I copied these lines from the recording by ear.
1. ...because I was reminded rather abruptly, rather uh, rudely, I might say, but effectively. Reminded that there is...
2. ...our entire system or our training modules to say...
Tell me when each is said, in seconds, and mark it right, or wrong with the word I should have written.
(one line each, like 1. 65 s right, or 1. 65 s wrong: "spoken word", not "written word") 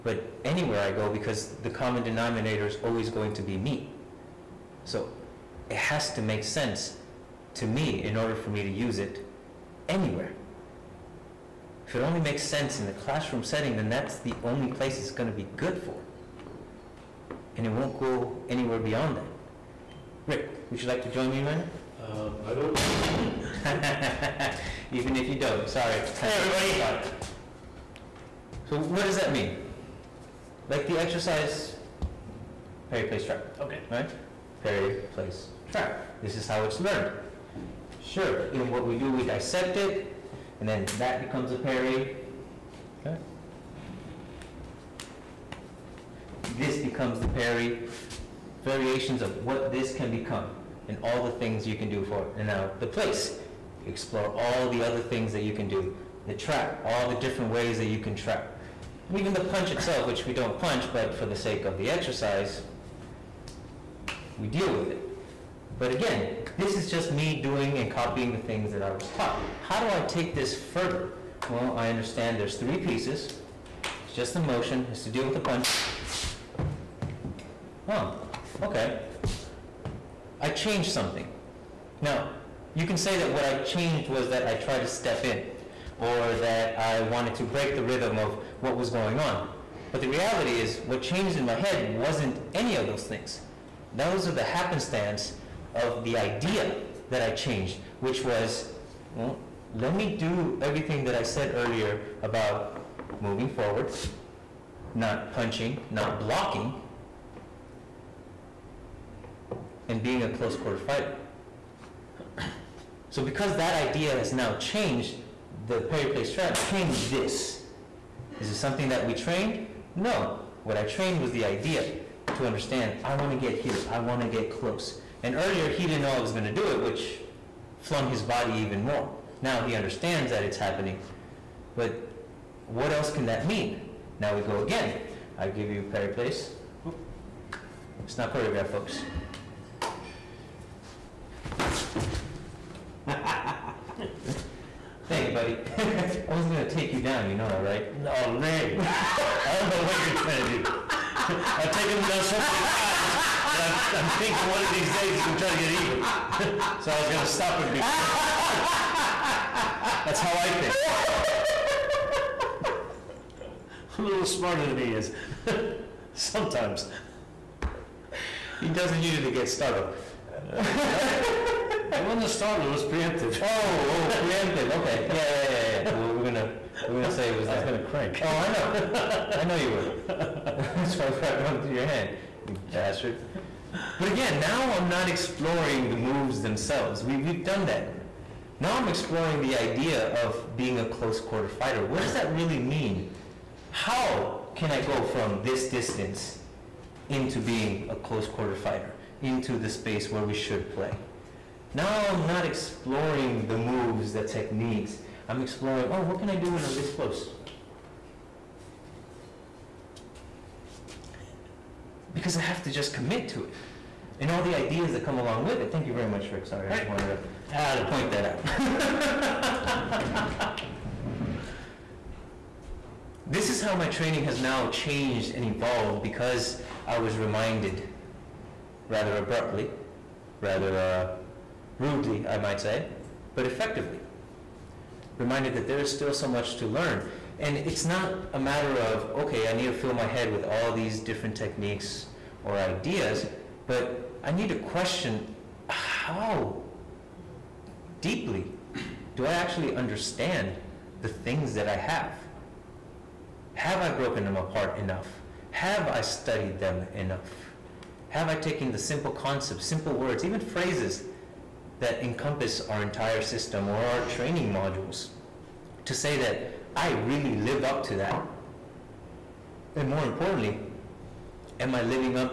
1. 226 s right
2. 262 s right.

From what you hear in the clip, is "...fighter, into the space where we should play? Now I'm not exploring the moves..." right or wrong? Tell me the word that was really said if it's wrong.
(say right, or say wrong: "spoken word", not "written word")
right.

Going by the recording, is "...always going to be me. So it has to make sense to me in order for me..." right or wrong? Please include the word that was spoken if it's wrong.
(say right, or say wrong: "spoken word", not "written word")
right.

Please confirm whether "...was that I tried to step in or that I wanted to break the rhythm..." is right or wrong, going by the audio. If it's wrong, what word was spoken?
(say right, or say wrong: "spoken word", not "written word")
right.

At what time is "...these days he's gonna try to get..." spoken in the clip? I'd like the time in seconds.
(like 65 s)
154 s.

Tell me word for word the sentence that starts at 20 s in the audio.
Rick, would you like to join me, Ryan?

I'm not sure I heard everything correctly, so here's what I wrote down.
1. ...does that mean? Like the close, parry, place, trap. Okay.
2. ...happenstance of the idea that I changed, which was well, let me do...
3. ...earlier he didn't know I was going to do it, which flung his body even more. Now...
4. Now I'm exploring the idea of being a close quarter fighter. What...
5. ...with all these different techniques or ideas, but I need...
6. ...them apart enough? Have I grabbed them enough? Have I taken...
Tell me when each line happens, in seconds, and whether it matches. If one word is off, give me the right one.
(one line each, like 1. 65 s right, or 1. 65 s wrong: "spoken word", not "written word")
1. 29 s wrong: "exercise", not "close"
2. 94 s right
3. 125 s right
4. 188 s right
5. 240 s right
6. 254 s wrong: "studied", not "grabbed".